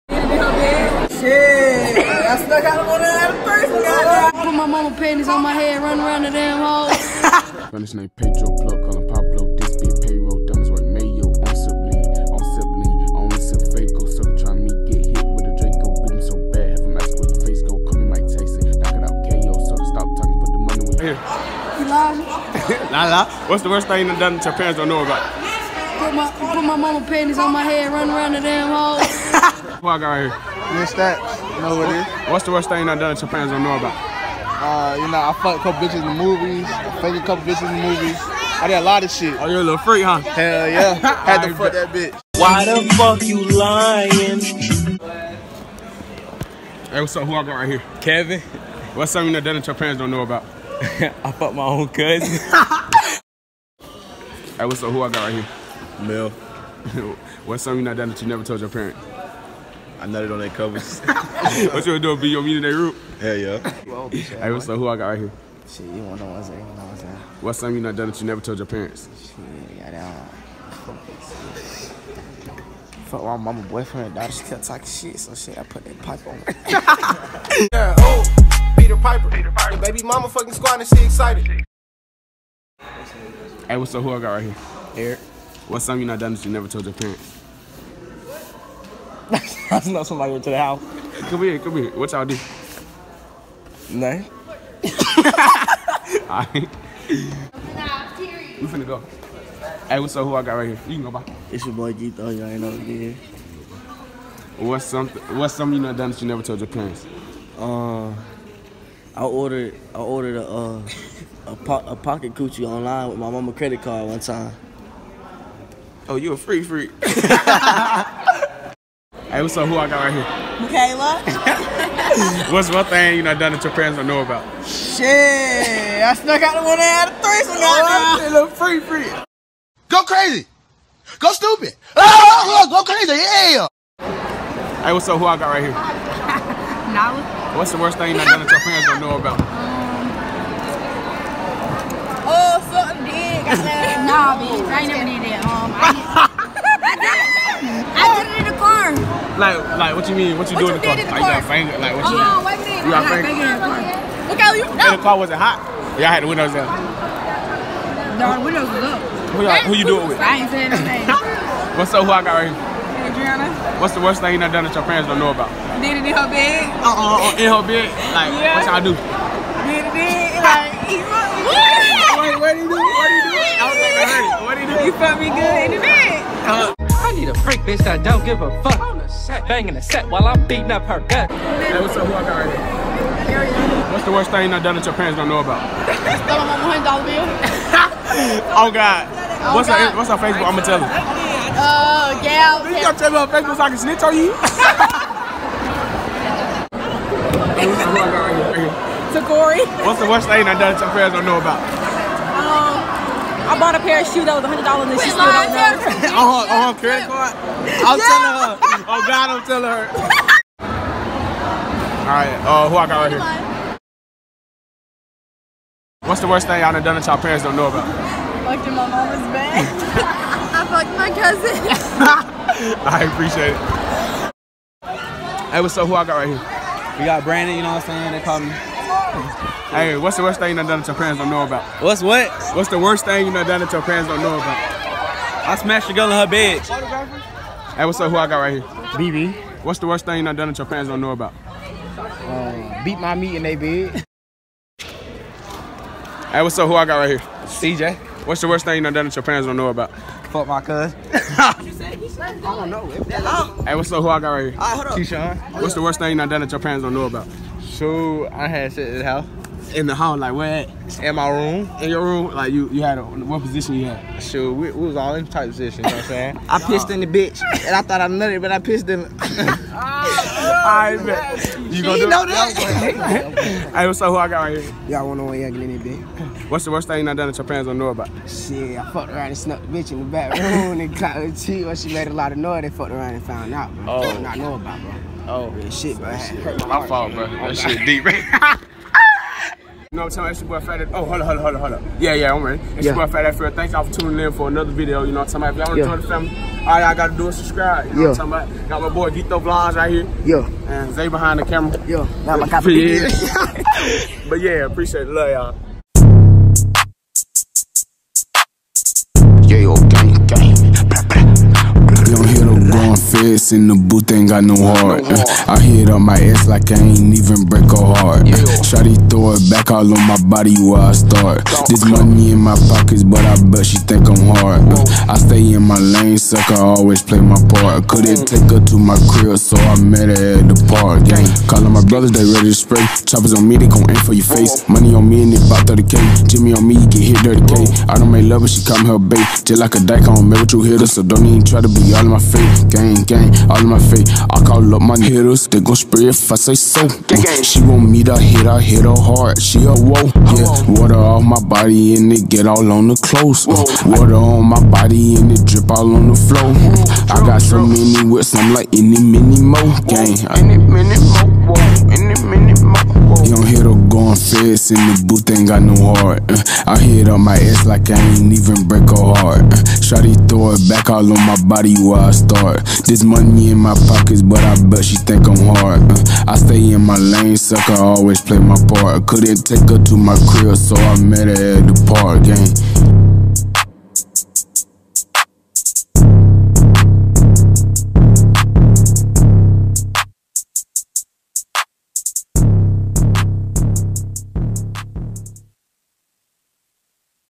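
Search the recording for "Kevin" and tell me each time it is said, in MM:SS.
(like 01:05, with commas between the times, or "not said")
00:48.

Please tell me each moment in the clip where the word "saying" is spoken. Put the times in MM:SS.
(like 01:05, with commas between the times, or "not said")
02:40, 03:48, 04:26.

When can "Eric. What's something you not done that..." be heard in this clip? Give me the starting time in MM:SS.
01:24.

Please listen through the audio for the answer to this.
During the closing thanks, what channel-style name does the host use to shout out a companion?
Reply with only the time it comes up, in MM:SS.
04:59.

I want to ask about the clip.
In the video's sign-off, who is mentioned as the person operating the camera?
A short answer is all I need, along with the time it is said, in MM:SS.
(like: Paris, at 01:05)
Zay, at 05:00.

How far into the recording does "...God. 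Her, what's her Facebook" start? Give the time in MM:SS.
03:09.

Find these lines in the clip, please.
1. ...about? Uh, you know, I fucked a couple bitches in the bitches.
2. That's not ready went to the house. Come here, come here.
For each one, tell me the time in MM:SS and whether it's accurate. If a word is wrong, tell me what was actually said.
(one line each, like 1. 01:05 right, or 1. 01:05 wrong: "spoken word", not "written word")
1. 00:33 wrong: "movies", not "bitches"
2. 01:29 wrong: "somebody", not "ready".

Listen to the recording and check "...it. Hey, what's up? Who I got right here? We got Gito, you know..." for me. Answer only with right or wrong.
wrong.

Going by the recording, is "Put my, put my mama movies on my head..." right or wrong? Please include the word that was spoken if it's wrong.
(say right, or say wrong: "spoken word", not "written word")
wrong: "panties", not "movies".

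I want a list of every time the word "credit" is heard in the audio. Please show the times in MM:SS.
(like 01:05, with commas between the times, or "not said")
01:53, 03:26.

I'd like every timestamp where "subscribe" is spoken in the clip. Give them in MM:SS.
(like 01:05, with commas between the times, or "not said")
04:57.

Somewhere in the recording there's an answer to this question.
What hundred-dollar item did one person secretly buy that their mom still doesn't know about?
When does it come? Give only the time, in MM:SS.
03:24.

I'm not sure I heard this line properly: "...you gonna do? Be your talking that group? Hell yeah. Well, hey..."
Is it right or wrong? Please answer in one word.
wrong.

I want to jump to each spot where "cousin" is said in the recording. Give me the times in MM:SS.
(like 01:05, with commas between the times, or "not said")
00:51, 03:41.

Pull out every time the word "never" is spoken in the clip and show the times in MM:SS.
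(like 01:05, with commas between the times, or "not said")
00:58, 01:08, 01:26, 01:46, 02:24.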